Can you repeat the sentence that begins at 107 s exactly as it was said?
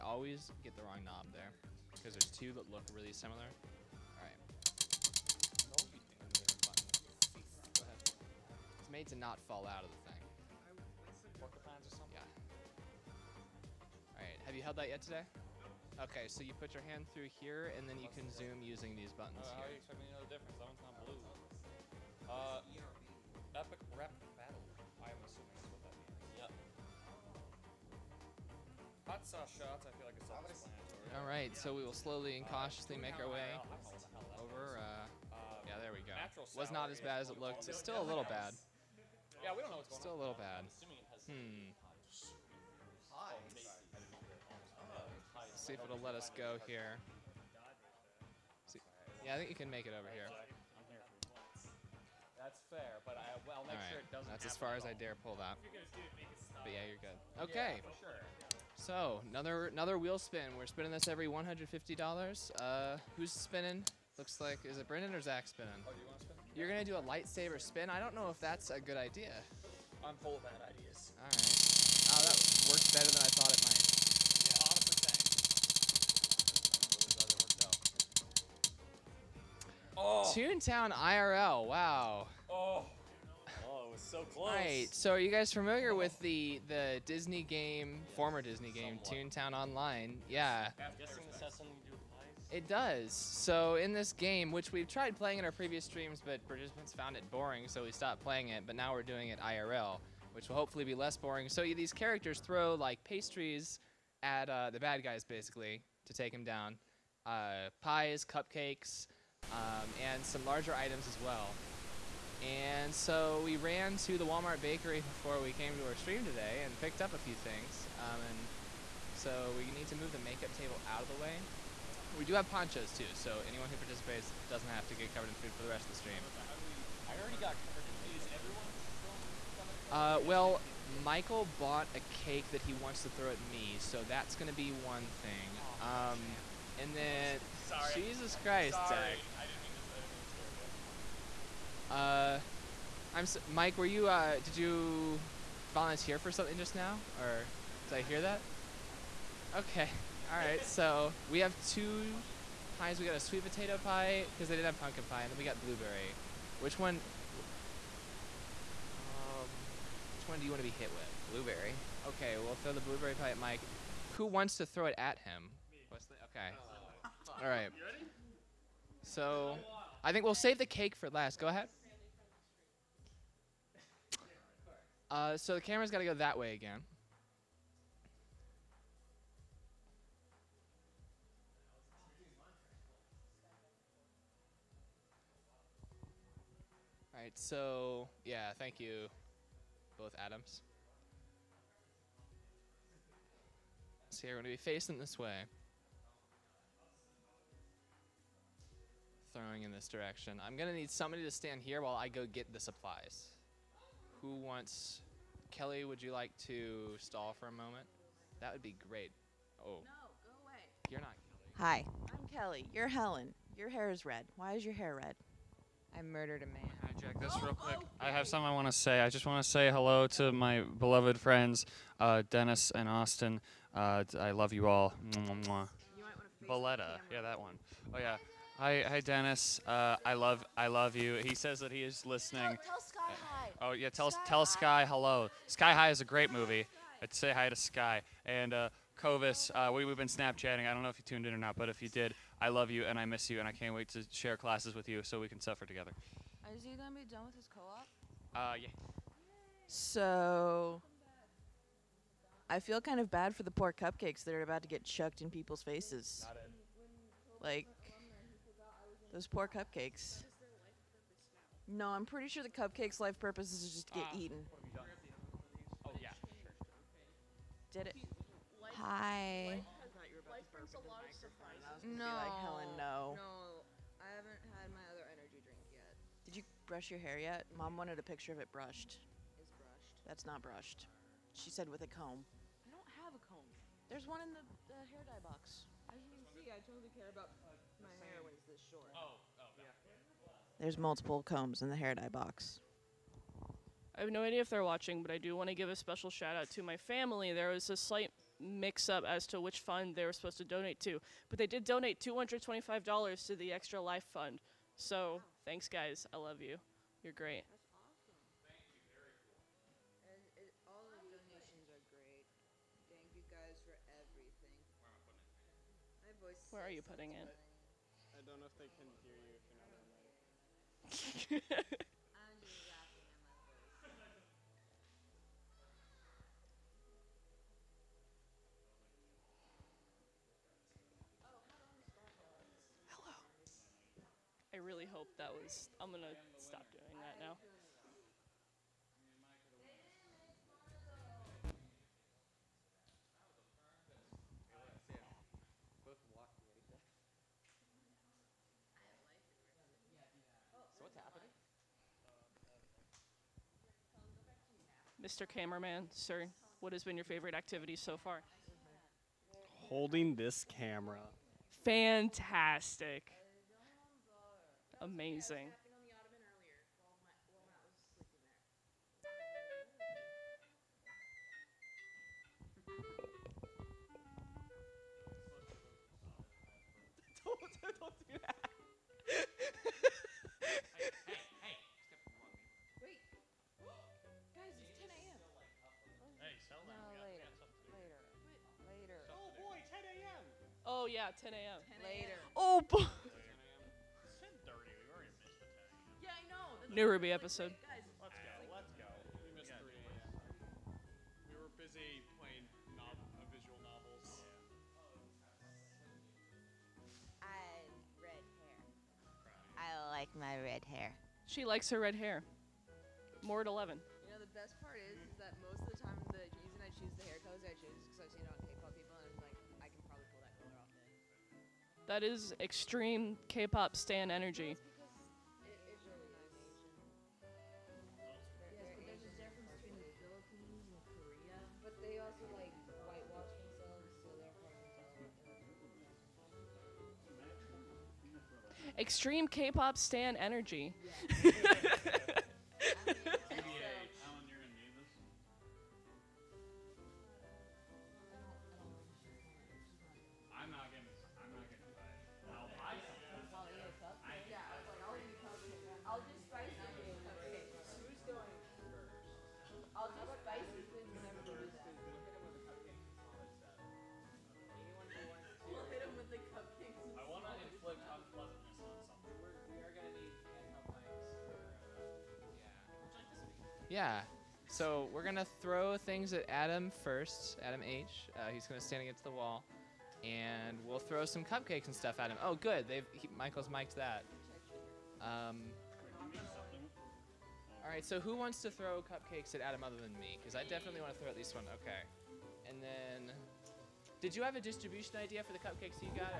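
Uh, pies, cupcakes, um, and some larger items as well.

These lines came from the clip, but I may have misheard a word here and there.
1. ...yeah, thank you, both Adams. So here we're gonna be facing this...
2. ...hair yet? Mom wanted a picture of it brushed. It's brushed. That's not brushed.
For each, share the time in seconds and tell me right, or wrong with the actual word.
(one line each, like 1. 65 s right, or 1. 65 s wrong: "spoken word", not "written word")
1. 188 s right
2. 276 s right.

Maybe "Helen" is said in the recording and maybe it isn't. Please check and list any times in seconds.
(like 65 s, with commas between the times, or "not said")
212 s, 272 s.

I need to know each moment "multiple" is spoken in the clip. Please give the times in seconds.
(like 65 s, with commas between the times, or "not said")
290 s.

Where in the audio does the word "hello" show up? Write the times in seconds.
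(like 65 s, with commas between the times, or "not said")
219 s, 234 s.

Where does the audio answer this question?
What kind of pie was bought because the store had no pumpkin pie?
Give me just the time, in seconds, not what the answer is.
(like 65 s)
153 s.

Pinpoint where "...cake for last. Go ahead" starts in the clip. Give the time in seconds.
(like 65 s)
170 s.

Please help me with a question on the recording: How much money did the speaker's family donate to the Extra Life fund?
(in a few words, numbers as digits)
$225.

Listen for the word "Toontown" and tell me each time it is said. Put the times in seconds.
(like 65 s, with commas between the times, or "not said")
80 s, 89 s.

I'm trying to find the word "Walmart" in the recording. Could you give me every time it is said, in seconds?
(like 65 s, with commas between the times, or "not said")
114 s.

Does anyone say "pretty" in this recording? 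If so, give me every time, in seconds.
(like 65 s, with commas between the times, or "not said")
262 s.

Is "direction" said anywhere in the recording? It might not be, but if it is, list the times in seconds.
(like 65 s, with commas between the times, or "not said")
199 s.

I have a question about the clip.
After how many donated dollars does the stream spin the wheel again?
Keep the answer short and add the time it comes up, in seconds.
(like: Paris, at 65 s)
$150, at 61 s.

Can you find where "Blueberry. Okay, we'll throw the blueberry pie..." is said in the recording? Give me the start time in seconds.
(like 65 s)
161 s.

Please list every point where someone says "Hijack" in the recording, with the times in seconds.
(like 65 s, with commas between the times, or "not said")
216 s.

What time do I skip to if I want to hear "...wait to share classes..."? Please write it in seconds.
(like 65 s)
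243 s.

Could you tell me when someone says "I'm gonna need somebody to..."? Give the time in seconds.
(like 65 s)
200 s.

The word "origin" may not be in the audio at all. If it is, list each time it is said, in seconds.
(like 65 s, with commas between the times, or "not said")
not said.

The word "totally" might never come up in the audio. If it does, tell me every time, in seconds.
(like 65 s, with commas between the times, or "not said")
286 s.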